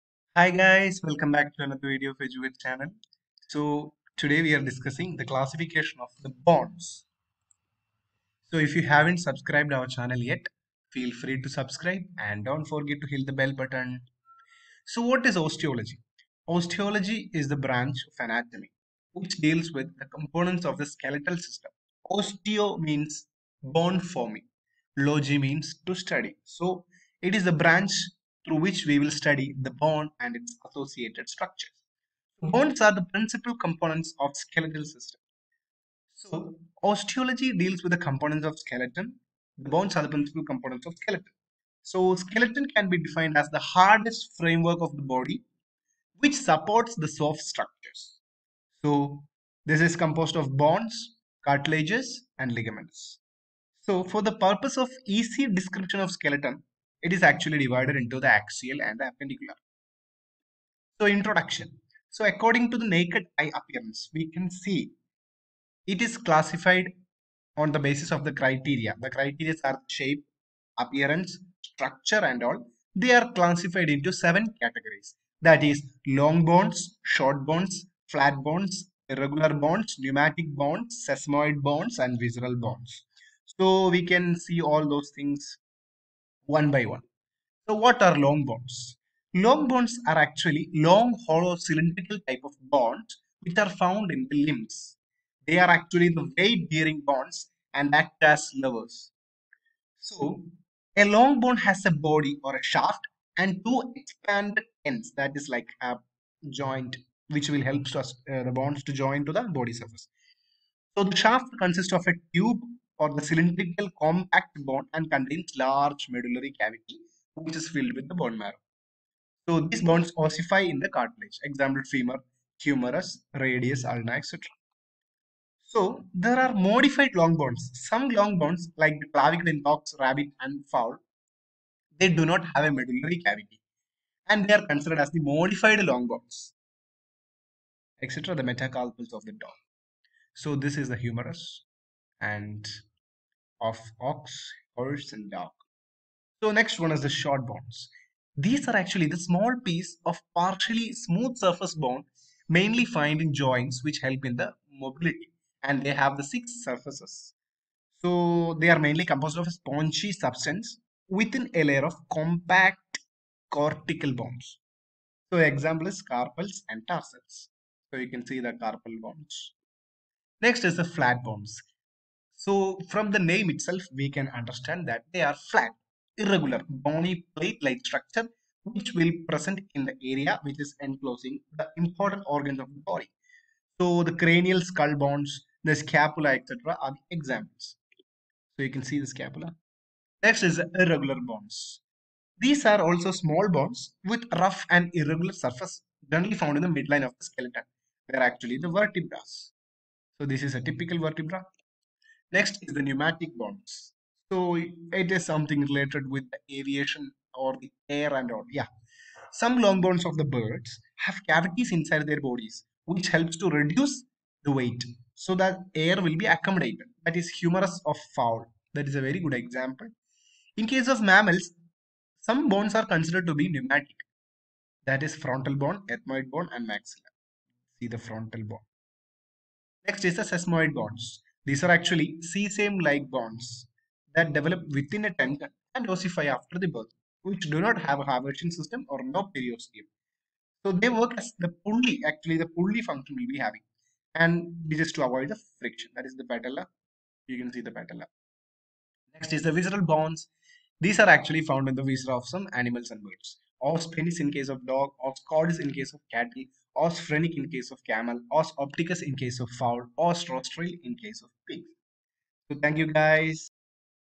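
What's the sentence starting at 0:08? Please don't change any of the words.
So if you haven't subscribed our channel yet, feel free to subscribe and don't forget to hit the bell button.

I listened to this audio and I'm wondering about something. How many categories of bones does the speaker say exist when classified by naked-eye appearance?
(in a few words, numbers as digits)
7.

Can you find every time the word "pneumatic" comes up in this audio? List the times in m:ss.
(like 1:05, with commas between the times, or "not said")
1:19, 3:22, 3:43.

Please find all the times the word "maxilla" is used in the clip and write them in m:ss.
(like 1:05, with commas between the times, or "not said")
3:46.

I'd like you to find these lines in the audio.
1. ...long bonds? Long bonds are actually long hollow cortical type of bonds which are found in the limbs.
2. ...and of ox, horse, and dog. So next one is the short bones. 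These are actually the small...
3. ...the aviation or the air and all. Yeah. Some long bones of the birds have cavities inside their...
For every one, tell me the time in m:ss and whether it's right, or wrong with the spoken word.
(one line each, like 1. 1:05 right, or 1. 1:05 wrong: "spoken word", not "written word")
1. 1:28 wrong: "cylindrical", not "cortical"
2. 2:22 right
3. 3:26 right.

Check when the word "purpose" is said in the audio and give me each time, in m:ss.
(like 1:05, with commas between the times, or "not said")
0:54.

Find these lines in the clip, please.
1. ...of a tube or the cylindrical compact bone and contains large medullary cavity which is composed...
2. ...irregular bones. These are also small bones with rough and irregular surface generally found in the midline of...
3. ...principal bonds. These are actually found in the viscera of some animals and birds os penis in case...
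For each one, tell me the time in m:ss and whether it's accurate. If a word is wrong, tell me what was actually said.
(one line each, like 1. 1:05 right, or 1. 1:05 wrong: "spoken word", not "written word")
1. 1:51 wrong: "filled", not "composed"
2. 3:10 right
3. 4:09 wrong: "visceral", not "principal".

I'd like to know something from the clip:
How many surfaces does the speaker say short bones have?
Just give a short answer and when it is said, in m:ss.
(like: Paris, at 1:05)
6, at 2:36.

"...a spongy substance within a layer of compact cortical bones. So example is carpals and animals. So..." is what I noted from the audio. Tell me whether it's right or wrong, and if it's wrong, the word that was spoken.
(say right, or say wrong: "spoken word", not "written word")
wrong: "tarsals", not "animals".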